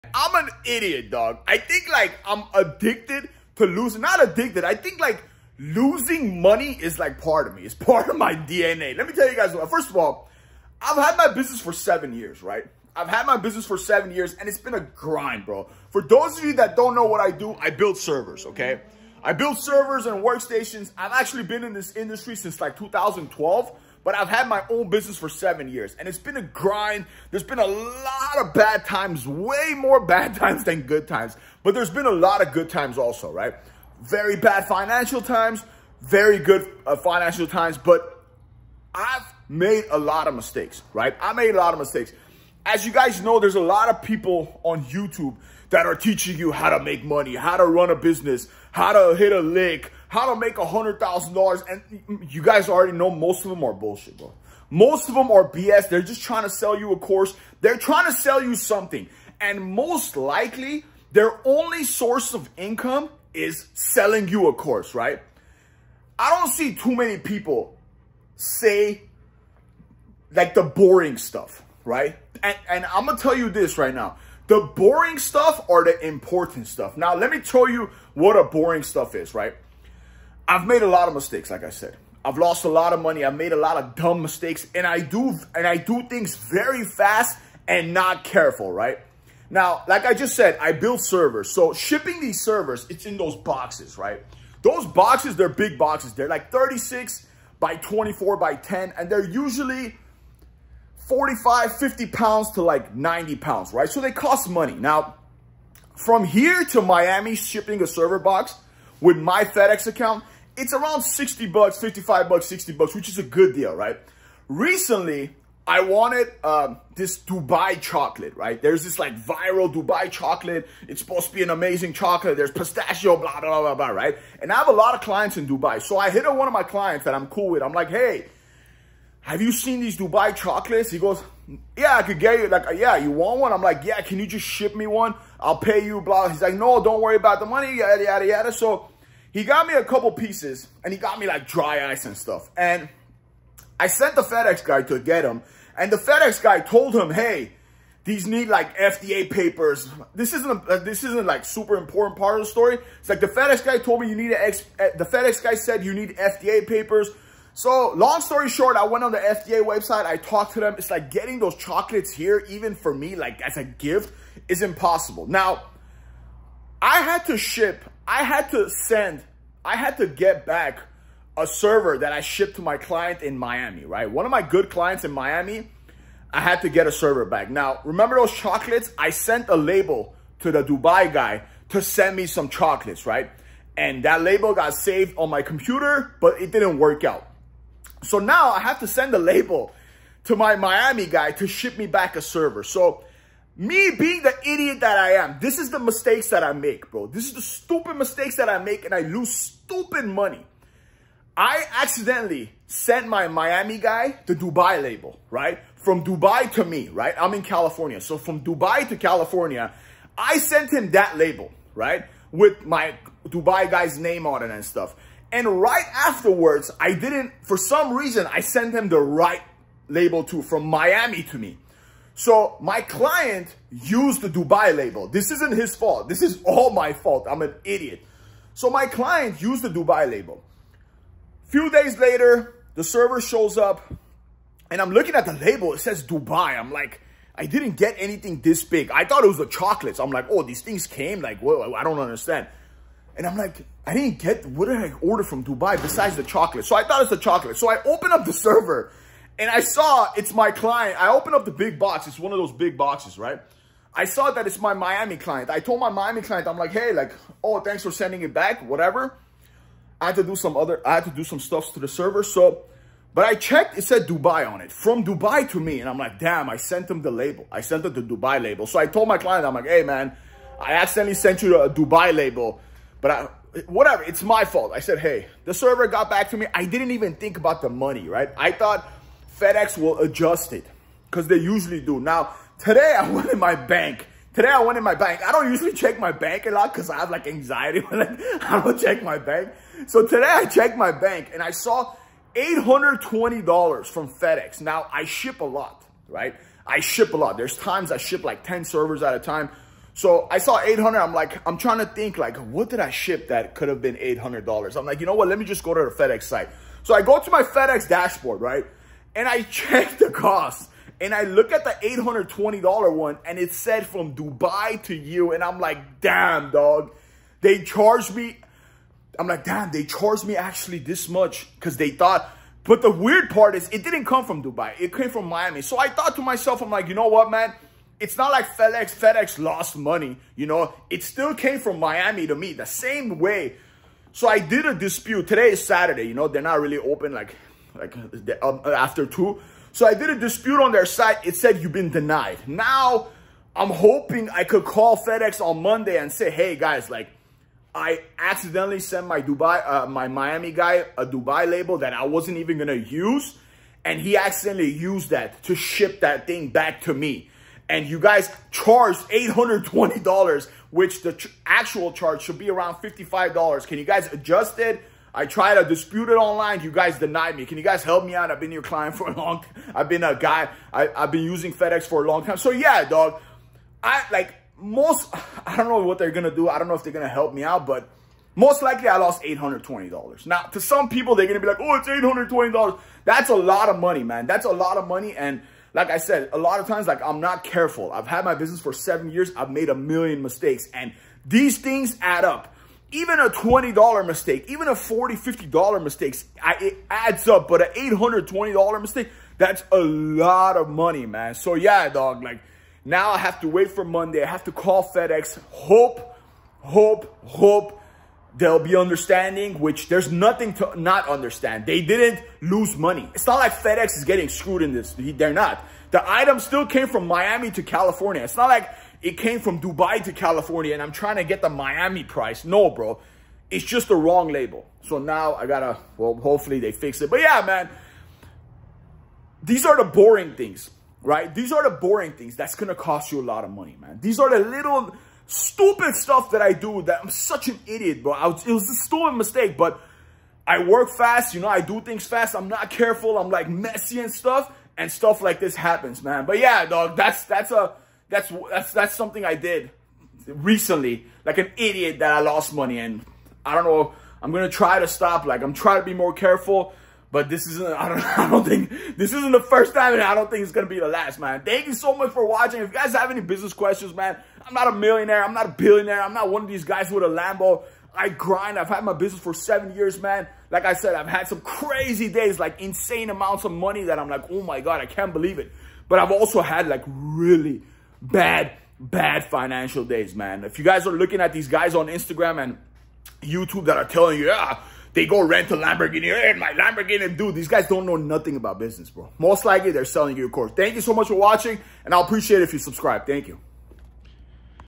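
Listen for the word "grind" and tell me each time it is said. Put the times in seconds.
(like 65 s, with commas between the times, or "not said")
14 s, 26 s, 468 s.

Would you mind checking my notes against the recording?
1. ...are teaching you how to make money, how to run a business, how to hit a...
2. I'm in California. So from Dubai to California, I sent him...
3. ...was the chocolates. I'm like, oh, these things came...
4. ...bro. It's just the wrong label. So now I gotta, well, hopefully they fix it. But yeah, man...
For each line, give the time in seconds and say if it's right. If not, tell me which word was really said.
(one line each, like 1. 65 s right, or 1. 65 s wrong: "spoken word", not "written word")
1. 45 s right
2. 207 s right
3. 239 s right
4. 422 s right.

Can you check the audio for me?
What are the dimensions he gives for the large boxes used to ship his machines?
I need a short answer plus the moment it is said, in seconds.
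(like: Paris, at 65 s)
36 by 24 by 10, at 96 s.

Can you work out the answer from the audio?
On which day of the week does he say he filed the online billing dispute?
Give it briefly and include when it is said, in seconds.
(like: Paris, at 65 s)
Saturday, at 335 s.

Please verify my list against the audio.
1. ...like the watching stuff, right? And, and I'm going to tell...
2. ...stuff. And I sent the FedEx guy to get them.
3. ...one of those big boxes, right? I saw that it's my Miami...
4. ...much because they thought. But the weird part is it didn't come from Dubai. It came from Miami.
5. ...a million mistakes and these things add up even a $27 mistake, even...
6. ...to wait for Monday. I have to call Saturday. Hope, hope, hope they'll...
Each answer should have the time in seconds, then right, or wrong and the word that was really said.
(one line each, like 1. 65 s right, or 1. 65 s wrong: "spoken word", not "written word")
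1. 70 s wrong: "boring", not "watching"
2. 142 s right
3. 252 s right
4. 321 s right
5. 389 s wrong: "20", not "27"
6. 403 s wrong: "FedEx", not "Saturday".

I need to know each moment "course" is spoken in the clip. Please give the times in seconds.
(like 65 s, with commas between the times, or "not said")
56 s, 64 s, 490 s.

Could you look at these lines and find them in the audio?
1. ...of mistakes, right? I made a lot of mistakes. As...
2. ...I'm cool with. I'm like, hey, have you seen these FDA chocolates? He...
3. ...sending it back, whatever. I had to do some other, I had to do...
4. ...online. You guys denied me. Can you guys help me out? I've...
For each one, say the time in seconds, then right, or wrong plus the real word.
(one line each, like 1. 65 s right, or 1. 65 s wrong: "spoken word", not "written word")
1. 40 s right
2. 127 s wrong: "Dubai", not "FDA"
3. 257 s right
4. 366 s right.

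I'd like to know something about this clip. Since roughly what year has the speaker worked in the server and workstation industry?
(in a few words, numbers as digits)
2012.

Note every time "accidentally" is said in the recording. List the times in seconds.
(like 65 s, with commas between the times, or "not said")
201 s, 270 s, 348 s, 354 s.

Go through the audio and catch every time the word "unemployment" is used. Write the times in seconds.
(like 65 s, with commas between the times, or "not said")
not said.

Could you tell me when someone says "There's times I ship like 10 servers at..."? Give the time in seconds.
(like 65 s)
297 s.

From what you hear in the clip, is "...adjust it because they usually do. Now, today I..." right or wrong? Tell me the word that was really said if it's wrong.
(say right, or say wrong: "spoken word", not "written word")
right.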